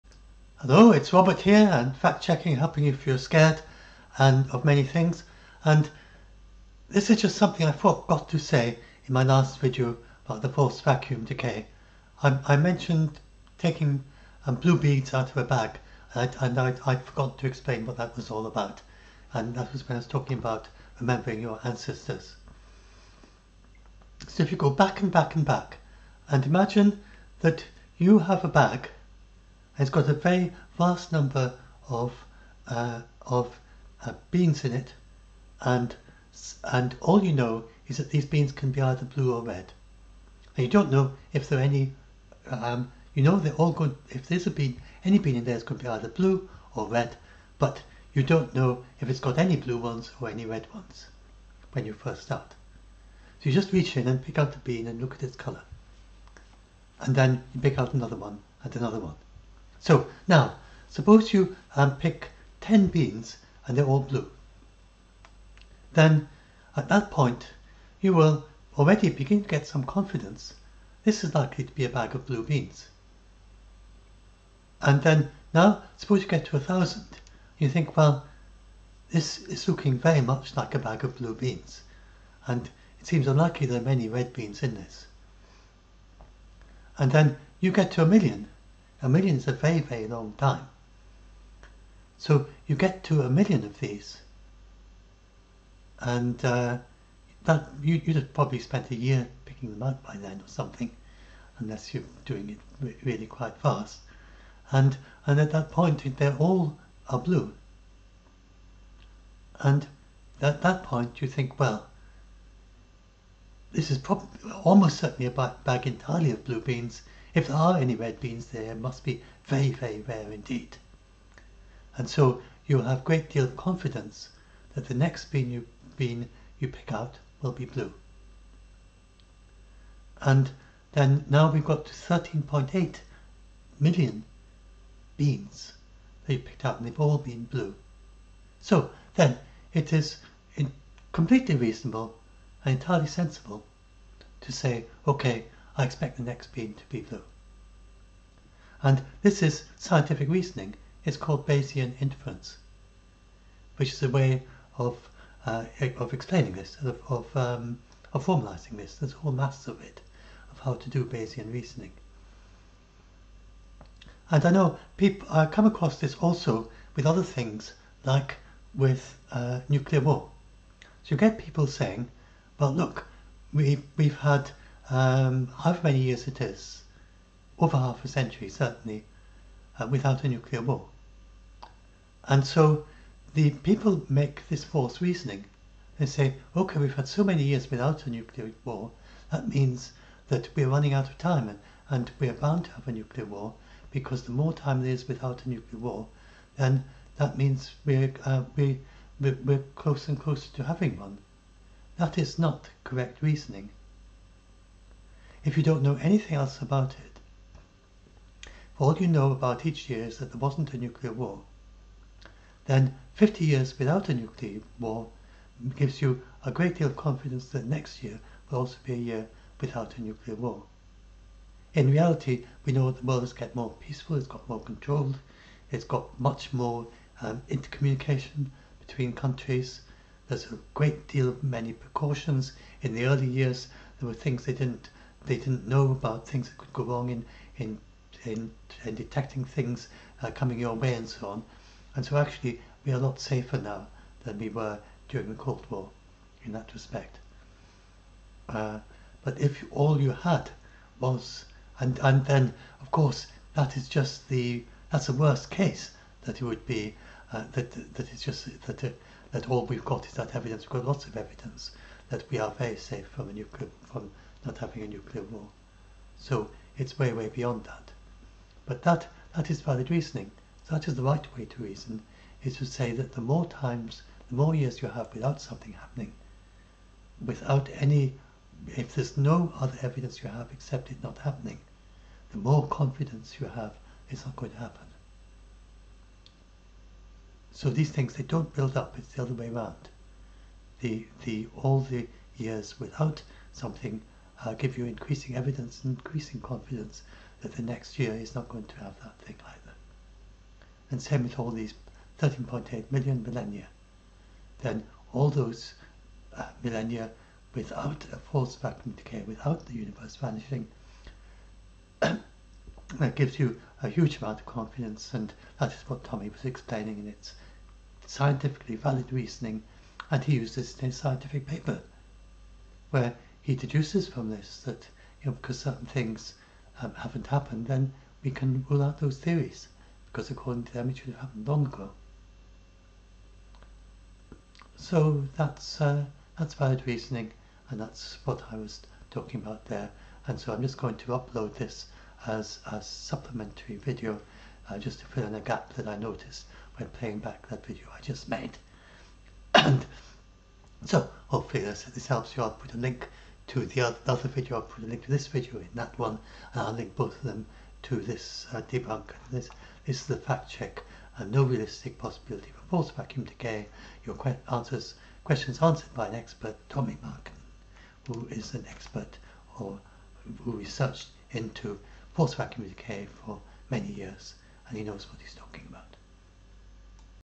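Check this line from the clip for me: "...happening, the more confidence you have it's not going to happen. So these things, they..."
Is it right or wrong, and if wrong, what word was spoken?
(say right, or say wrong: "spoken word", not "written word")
right.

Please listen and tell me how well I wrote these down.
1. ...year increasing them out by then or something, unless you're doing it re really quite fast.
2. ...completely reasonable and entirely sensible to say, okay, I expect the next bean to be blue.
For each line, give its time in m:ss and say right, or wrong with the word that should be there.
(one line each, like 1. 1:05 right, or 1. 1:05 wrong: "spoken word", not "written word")
1. 1:38 wrong: "picking", not "increasing"
2. 2:21 right.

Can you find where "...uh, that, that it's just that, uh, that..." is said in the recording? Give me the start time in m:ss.
4:17.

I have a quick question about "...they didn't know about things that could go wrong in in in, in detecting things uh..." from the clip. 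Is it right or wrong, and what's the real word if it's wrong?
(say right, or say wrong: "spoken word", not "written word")
right.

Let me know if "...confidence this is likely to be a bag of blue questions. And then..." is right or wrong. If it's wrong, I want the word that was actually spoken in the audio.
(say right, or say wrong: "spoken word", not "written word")
wrong: "beans", not "questions".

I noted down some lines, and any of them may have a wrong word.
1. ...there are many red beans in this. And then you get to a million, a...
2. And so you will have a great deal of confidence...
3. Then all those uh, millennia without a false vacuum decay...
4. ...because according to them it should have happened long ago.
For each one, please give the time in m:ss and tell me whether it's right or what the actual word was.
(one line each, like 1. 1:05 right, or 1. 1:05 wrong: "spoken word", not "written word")
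1. 1:23 right
2. 2:01 right
3. 5:04 right
4. 5:30 right.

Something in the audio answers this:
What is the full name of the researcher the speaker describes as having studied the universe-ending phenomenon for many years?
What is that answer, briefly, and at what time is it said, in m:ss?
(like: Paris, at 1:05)
Tommi Markkanen, at 6:06.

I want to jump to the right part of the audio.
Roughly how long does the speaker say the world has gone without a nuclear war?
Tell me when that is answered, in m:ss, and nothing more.
2:57.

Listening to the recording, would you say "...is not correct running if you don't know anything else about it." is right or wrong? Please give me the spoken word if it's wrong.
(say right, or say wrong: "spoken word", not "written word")
wrong: "reasoning", not "running".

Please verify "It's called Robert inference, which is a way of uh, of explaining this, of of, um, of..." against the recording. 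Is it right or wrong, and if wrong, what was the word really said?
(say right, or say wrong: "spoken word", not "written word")
wrong: "Bayesian", not "Robert".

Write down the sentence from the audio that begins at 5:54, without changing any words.
I'll put a link to this video in that one and I'll link both of them to this uh, debunk.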